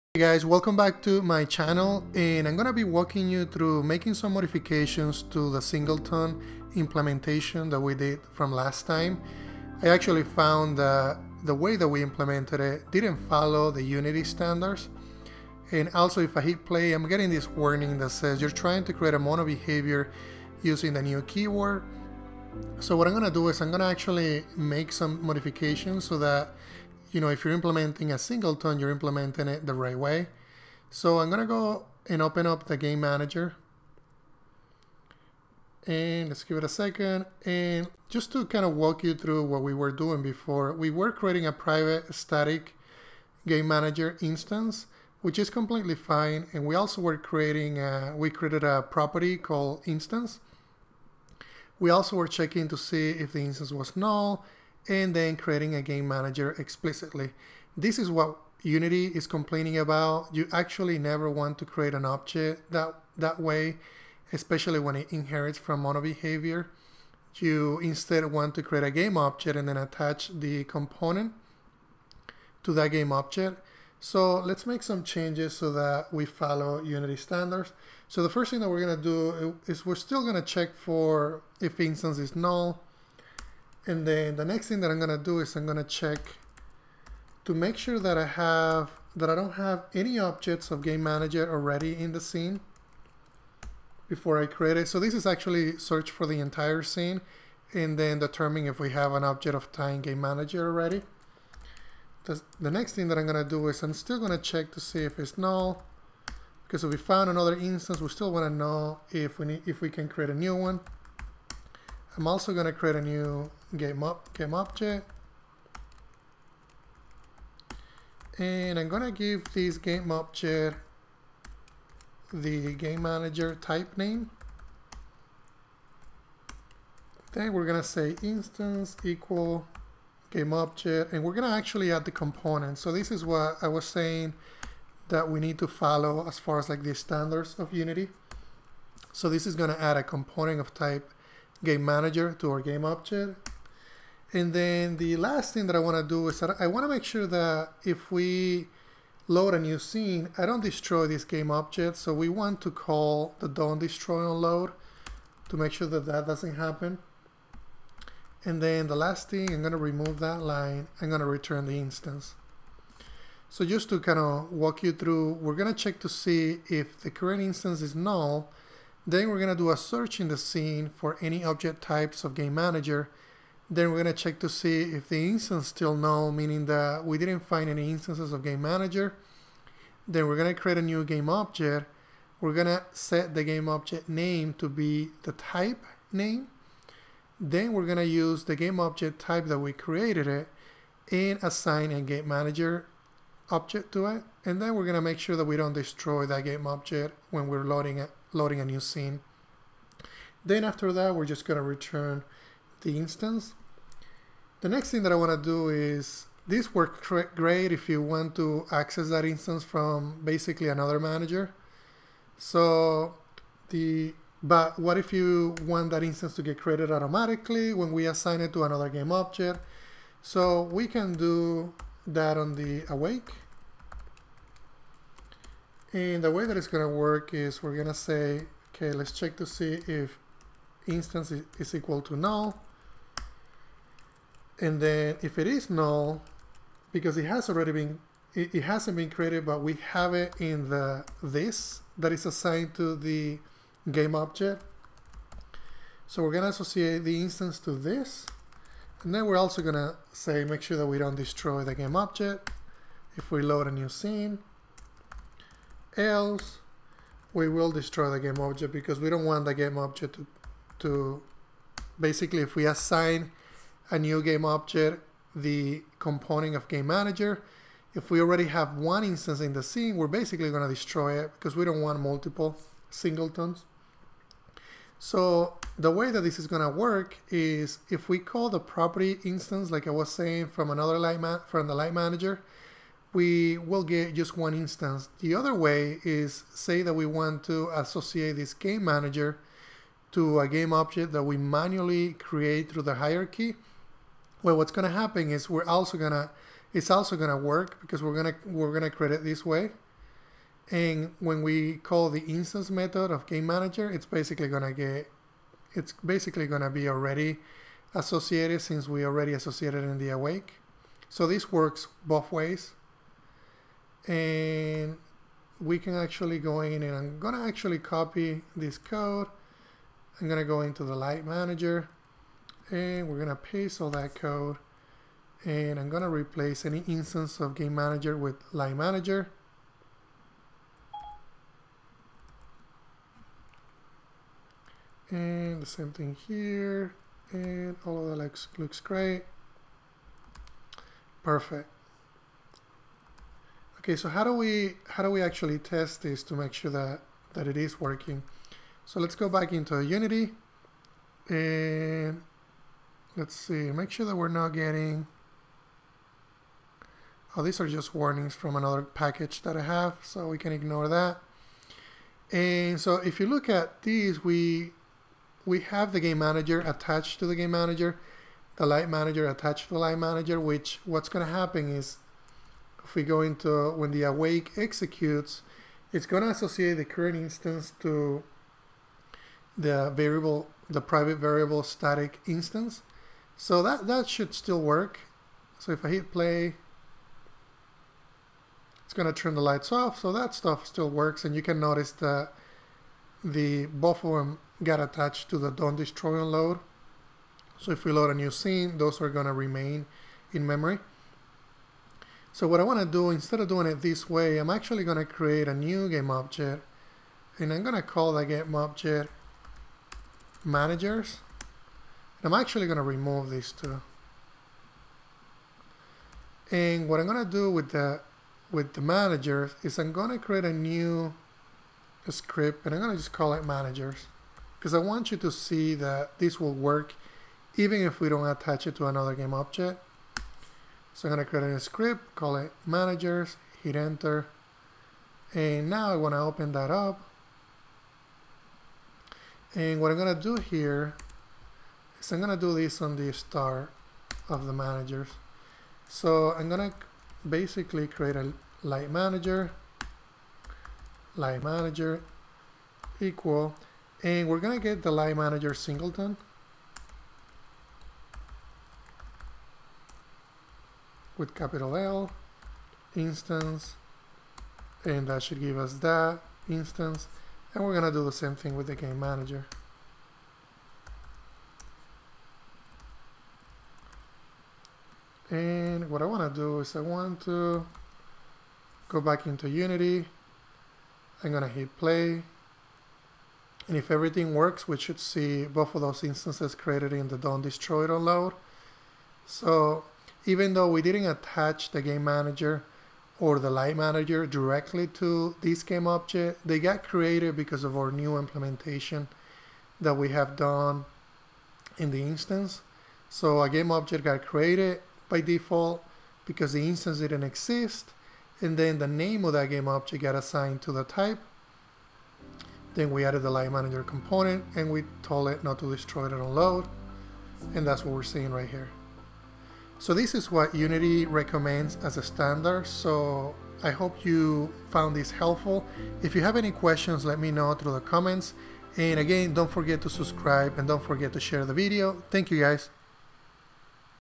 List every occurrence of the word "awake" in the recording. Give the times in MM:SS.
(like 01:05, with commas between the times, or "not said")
03:42, 05:10, 06:14.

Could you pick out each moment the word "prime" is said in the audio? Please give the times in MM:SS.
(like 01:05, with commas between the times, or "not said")
not said.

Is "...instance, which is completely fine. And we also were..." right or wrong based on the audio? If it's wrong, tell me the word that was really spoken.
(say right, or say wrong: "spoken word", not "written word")
right.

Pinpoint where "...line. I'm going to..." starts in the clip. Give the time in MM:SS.
02:40.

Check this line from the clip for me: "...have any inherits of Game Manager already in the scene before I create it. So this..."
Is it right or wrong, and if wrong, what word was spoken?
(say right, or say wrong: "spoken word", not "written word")
wrong: "objects", not "inherits".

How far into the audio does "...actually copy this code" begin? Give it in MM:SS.
05:17.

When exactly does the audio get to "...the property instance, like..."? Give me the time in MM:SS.
04:38.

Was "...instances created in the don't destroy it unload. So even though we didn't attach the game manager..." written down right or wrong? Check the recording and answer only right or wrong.
right.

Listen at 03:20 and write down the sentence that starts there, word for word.
Then after that, we're just going to return the instance.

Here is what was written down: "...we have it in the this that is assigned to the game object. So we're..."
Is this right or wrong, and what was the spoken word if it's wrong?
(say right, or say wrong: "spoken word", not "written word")
right.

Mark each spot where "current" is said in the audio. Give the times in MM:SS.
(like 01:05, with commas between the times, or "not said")
02:47, 06:16.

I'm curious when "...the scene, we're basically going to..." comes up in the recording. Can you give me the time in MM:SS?
04:29.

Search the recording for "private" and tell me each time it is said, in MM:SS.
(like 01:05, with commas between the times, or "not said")
00:41, 06:20.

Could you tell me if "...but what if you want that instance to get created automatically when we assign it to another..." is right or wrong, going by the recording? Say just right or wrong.
right.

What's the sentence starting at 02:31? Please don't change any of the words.
So we want to call the don't destroy on load to make sure that that doesn't happen.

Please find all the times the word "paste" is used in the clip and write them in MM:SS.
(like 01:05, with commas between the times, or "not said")
05:23.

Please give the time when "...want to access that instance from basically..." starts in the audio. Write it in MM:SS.
03:27.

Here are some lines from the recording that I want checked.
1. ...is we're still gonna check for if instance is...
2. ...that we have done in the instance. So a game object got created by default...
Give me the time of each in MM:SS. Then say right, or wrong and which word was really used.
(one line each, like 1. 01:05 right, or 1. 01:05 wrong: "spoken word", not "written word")
1. 01:19 right
2. 08:19 right.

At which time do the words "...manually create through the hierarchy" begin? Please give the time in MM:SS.
04:51.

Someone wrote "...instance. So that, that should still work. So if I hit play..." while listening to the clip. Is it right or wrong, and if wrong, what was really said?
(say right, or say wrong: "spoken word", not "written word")
right.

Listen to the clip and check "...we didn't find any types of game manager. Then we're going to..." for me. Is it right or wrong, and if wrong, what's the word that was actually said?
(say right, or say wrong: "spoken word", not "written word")
wrong: "instances", not "types".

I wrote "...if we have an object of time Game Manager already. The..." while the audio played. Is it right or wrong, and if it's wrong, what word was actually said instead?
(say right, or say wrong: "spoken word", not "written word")
right.